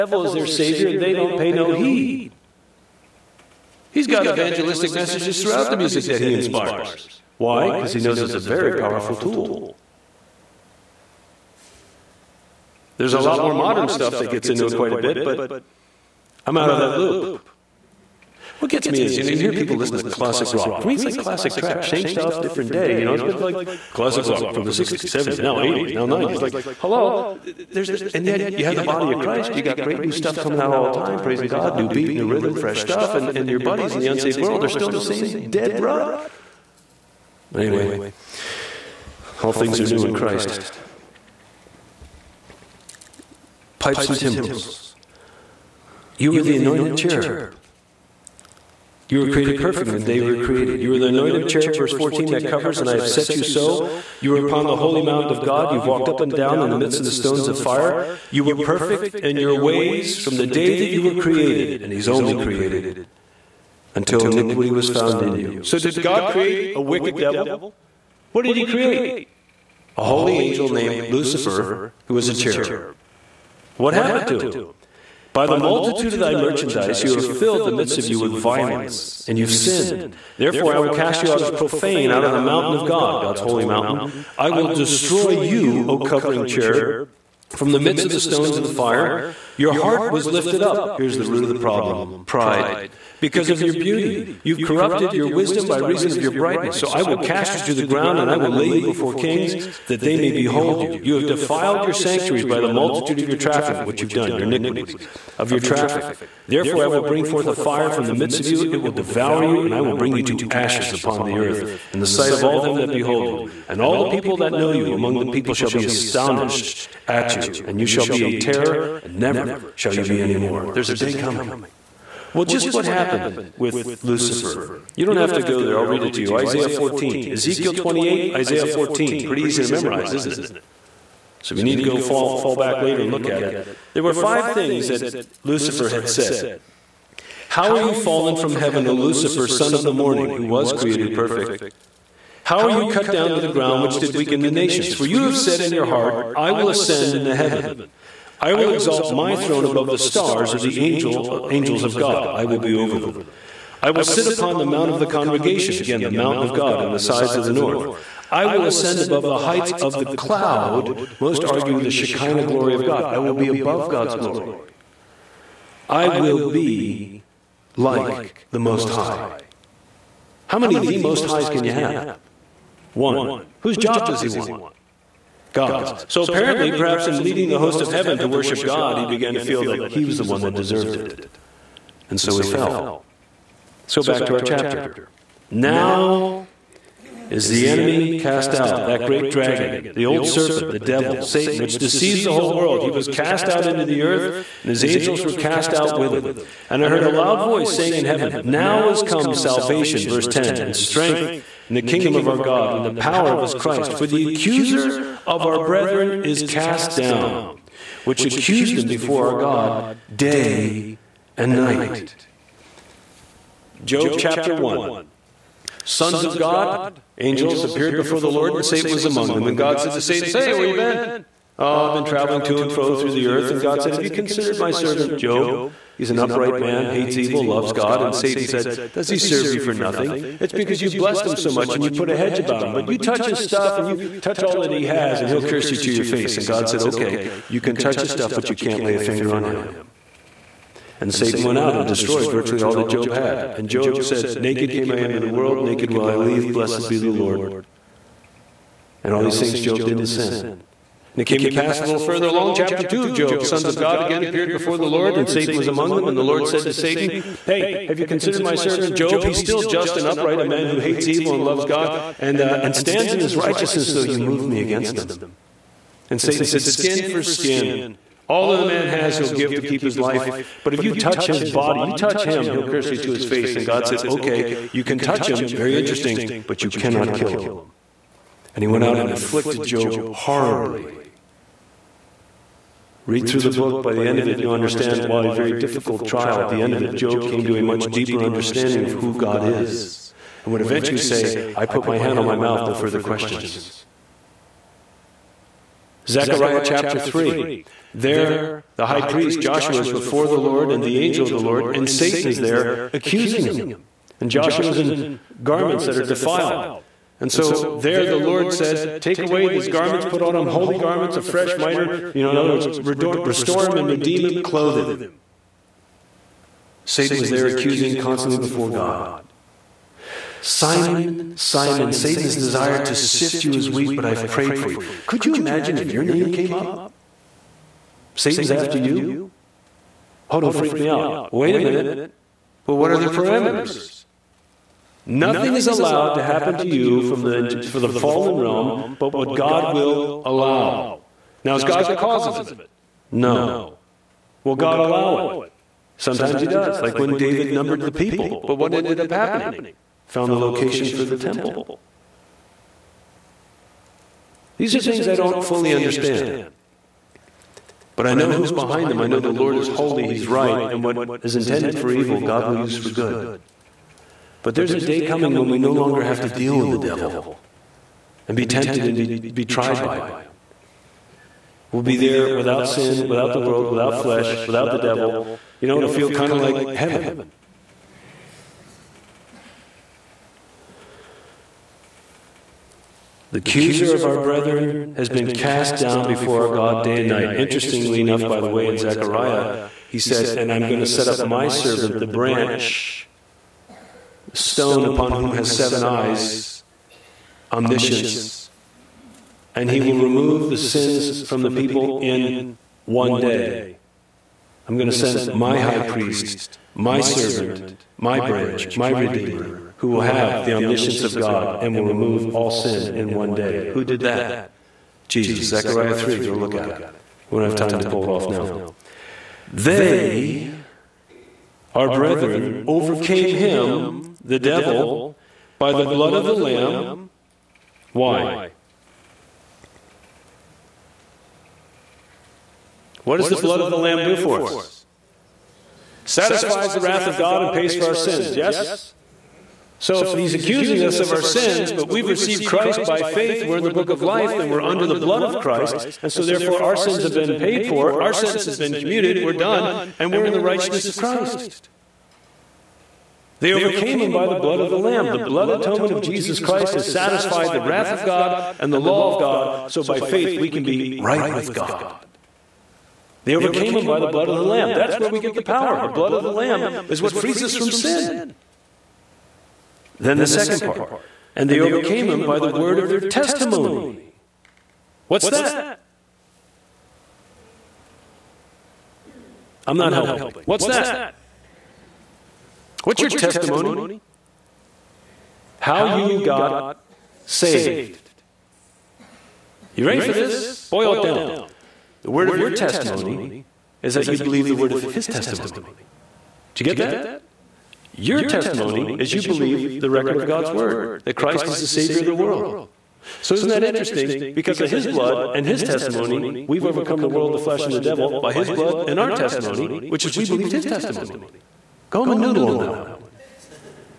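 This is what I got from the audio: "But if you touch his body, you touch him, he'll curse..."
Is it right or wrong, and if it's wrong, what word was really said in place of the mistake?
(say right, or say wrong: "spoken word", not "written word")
right.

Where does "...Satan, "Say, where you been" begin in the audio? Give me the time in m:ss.
3:40.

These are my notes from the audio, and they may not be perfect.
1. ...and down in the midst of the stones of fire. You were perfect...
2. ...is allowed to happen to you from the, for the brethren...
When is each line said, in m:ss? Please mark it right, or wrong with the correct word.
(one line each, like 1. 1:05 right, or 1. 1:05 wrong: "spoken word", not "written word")
1. 0:56 right
2. 5:35 wrong: "fallen", not "brethren".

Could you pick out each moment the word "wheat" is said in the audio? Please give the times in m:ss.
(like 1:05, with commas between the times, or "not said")
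5:23.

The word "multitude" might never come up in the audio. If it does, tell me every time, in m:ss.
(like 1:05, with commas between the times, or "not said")
1:15, 1:42.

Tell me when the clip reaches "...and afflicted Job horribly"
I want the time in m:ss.
4:38.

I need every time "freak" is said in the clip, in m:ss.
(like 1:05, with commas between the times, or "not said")
5:30.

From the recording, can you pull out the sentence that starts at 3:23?
For the accuser of our brethren is cast down, which accused them before our God day and night.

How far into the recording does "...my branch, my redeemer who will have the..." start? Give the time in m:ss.
6:47.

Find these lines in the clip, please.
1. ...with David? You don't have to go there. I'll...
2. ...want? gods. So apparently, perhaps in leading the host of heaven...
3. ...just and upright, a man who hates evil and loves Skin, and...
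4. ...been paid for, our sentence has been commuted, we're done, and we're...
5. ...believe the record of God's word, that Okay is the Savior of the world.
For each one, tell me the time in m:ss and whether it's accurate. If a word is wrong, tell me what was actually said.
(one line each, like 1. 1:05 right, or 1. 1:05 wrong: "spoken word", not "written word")
1. 2:03 wrong: "Lucifer", not "David"
2. 2:54 right
3. 4:19 wrong: "God", not "Skin"
4. 7:27 right
5. 8:19 wrong: "Christ", not "Okay".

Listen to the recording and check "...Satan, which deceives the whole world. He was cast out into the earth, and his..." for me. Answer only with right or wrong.
right.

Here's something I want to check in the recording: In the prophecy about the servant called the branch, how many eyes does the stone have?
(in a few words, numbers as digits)
7.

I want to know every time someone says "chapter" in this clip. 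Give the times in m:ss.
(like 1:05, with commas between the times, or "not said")
3:04, 3:34, 4:12, 4:56.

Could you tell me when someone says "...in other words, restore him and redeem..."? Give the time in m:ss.
5:12.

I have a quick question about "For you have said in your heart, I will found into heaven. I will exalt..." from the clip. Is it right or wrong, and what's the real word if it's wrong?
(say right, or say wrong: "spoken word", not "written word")
wrong: "ascend", not "found".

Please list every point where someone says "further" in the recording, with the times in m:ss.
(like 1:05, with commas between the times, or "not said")
4:12, 4:52.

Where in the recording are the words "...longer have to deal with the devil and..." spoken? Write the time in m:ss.
6:05.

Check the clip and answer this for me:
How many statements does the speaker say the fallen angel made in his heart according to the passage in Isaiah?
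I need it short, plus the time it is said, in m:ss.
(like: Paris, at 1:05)
5, at 2:14.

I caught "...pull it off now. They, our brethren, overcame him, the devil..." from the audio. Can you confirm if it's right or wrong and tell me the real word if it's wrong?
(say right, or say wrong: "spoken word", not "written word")
right.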